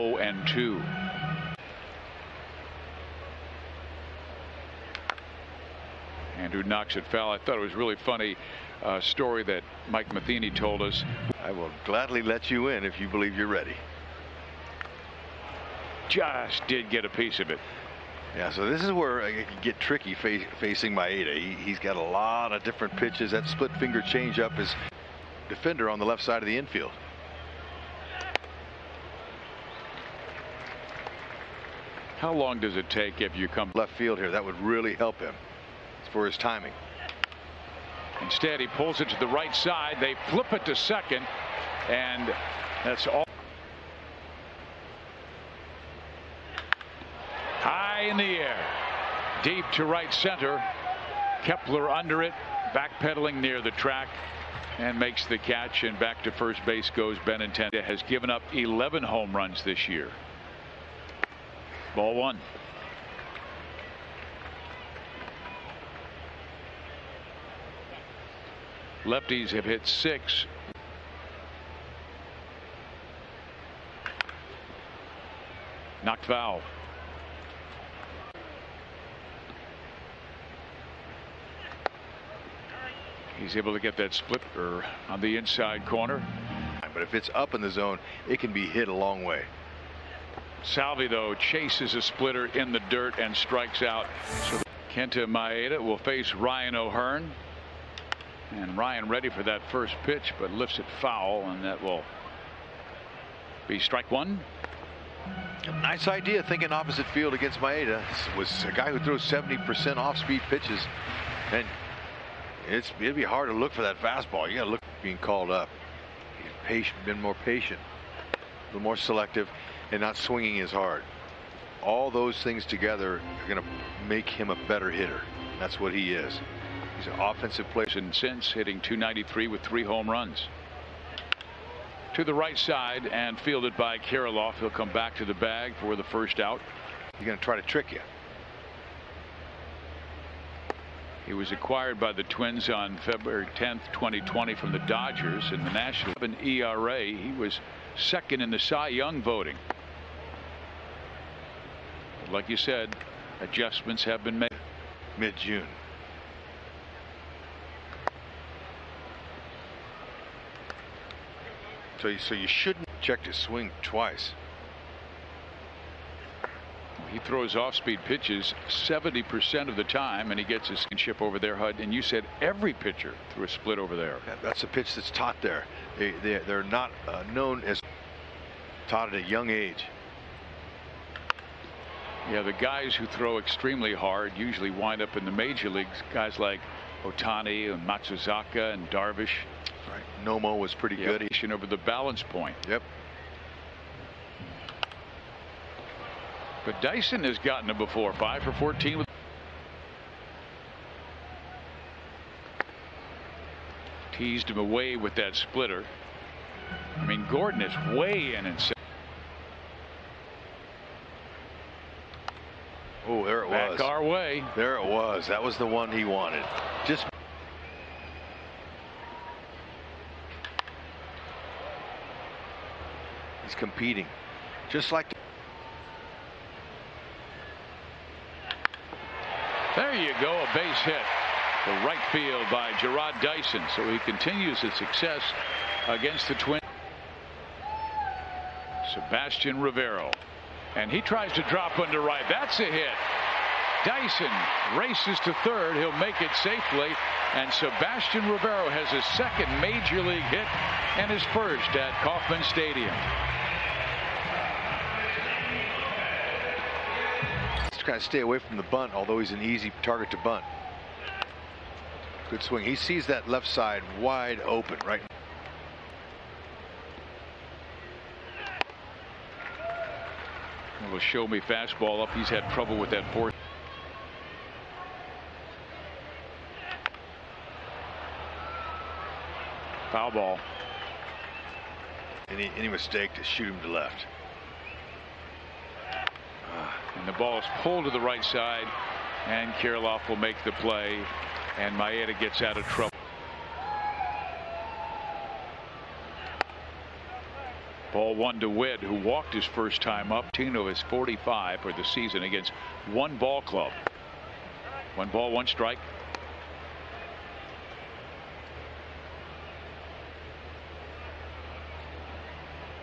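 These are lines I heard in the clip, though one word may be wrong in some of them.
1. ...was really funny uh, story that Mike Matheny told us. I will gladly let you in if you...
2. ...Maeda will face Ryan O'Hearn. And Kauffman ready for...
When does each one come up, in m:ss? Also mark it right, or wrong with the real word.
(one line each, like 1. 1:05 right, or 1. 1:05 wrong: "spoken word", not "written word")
1. 0:07 right
2. 1:35 wrong: "Ryan", not "Kauffman".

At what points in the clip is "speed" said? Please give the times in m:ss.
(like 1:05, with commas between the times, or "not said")
1:49, 2:47.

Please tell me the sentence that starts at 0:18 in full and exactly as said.
Yeah, so this is where can get tricky facing Maeda.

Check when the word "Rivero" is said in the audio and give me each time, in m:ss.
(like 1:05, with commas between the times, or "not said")
3:59, 4:08.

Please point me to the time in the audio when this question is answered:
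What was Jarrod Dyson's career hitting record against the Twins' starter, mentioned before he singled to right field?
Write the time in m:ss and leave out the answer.
3:18.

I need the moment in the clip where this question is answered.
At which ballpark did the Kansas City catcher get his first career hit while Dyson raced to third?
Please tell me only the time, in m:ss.
4:12.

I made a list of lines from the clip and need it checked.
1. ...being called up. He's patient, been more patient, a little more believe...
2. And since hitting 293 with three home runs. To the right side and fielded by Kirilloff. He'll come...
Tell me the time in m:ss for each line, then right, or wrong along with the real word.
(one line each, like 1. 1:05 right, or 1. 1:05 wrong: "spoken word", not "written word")
1. 1:55 wrong: "selective", not "believe"
2. 2:07 right.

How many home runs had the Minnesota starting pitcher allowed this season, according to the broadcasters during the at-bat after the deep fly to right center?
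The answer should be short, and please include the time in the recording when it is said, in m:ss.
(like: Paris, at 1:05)
11, at 0:58.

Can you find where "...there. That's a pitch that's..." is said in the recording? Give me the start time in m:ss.
2:53.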